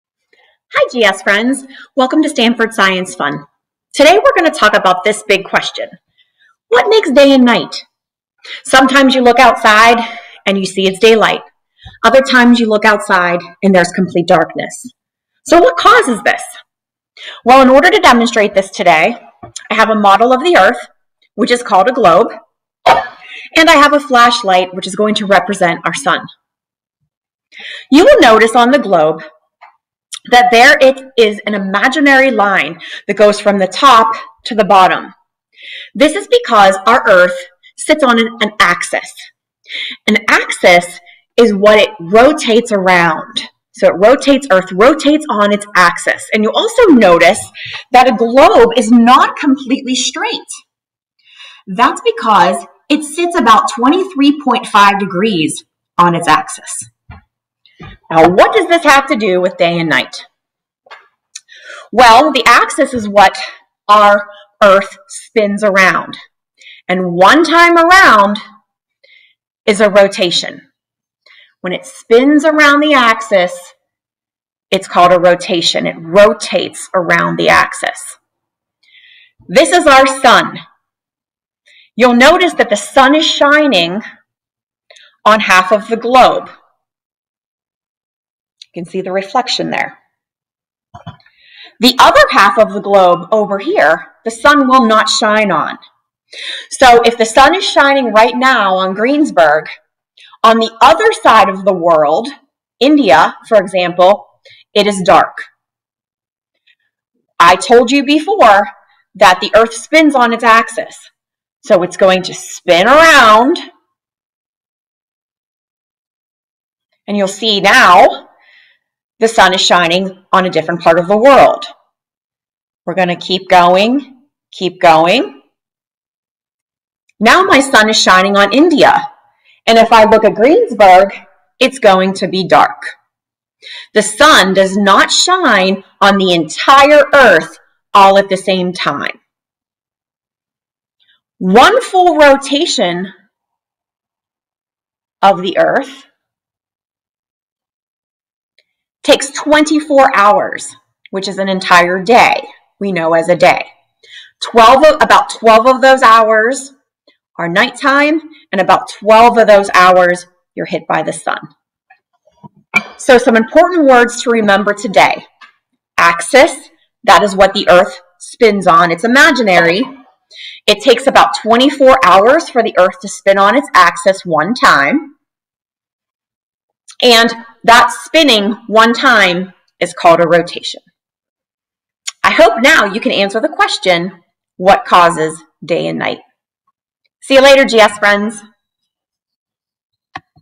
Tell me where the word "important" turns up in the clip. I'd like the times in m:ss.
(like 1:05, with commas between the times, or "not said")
2:43.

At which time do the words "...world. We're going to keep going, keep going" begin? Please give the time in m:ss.
2:01.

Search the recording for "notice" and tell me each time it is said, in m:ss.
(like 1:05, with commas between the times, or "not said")
0:28, 0:46, 1:22.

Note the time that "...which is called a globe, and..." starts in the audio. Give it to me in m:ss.
0:21.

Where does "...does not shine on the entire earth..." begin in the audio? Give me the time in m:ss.
2:14.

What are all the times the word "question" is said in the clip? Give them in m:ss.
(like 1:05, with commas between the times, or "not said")
0:05, 3:03.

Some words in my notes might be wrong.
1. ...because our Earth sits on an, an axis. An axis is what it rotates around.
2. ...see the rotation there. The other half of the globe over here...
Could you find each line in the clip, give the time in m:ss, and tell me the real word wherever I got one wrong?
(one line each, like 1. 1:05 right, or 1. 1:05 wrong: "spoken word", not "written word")
1. 0:36 right
2. 1:28 wrong: "reflection", not "rotation".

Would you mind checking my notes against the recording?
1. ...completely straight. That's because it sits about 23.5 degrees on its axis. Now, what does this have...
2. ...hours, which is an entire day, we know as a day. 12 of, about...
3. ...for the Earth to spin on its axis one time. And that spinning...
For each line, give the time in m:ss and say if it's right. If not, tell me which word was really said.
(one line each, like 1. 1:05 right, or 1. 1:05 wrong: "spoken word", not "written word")
1. 0:49 right
2. 2:30 right
3. 2:52 right.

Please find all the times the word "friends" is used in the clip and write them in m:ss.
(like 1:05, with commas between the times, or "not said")
0:01, 3:07.